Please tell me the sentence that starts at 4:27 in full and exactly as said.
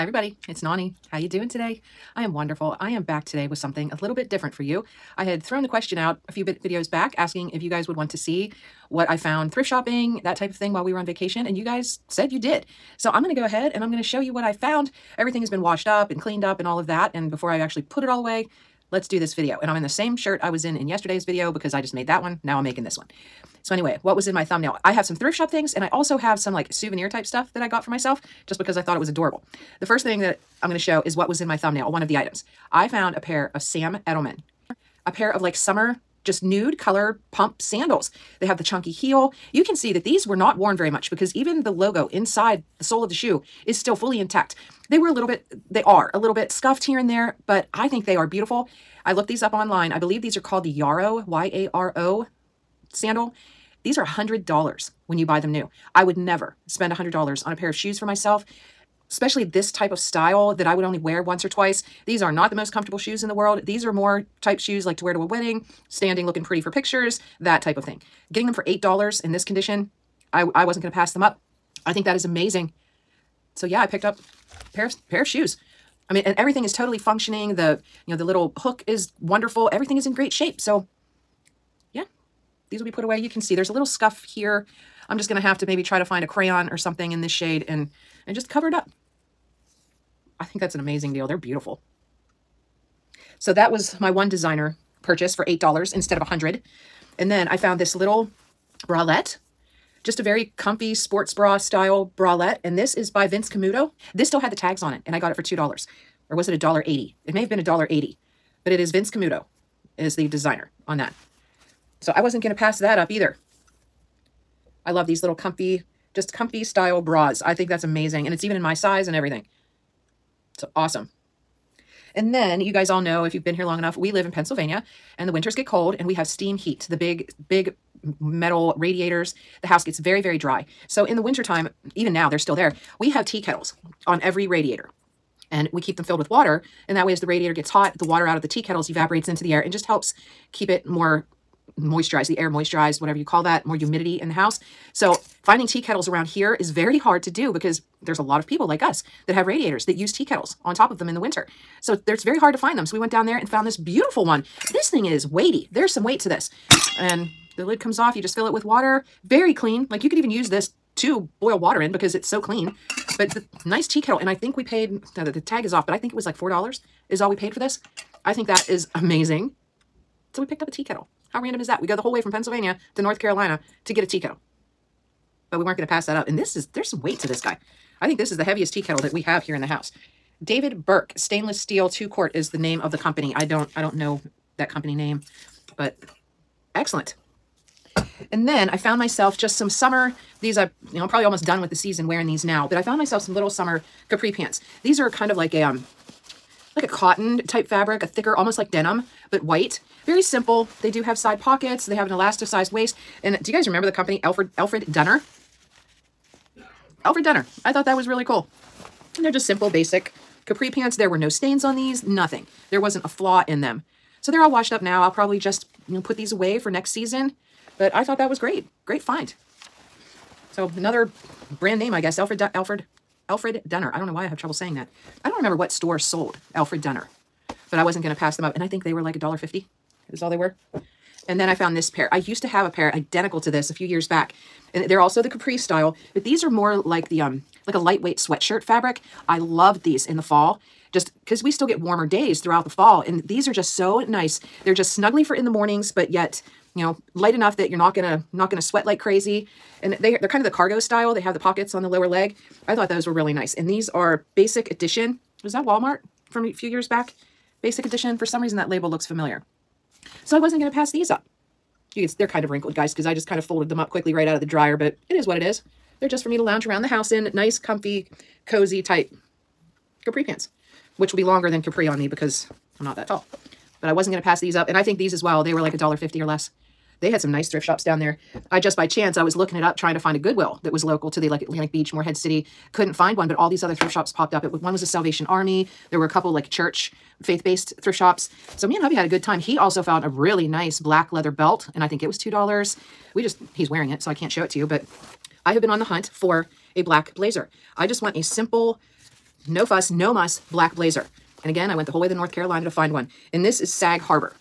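Nice, comfy, cozy type capri pants, which will be longer than capri on me because I'm not that tall.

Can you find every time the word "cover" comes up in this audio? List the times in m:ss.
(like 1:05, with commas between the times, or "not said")
1:28.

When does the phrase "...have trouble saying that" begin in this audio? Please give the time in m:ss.
3:44.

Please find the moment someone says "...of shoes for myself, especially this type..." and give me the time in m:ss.
0:57.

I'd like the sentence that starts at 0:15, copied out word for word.
Everything has been washed up and cleaned up and all of that.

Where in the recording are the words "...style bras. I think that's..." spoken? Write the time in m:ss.
1:56.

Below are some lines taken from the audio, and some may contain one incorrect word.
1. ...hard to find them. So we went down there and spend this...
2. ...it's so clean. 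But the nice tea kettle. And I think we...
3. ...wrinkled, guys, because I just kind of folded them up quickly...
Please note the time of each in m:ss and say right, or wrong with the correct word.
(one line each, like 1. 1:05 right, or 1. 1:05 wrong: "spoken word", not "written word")
1. 2:32 wrong: "found", not "spend"
2. 2:42 right
3. 4:22 right.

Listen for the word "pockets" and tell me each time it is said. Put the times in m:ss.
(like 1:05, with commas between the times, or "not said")
3:21, 4:11.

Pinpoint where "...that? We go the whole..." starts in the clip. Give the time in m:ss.
2:51.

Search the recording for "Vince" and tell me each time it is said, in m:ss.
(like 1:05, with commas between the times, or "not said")
1:43, 1:48.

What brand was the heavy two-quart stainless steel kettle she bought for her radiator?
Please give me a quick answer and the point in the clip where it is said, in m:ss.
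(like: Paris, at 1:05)
David Burke, at 3:00.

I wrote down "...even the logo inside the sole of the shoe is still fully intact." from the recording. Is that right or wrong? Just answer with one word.
right.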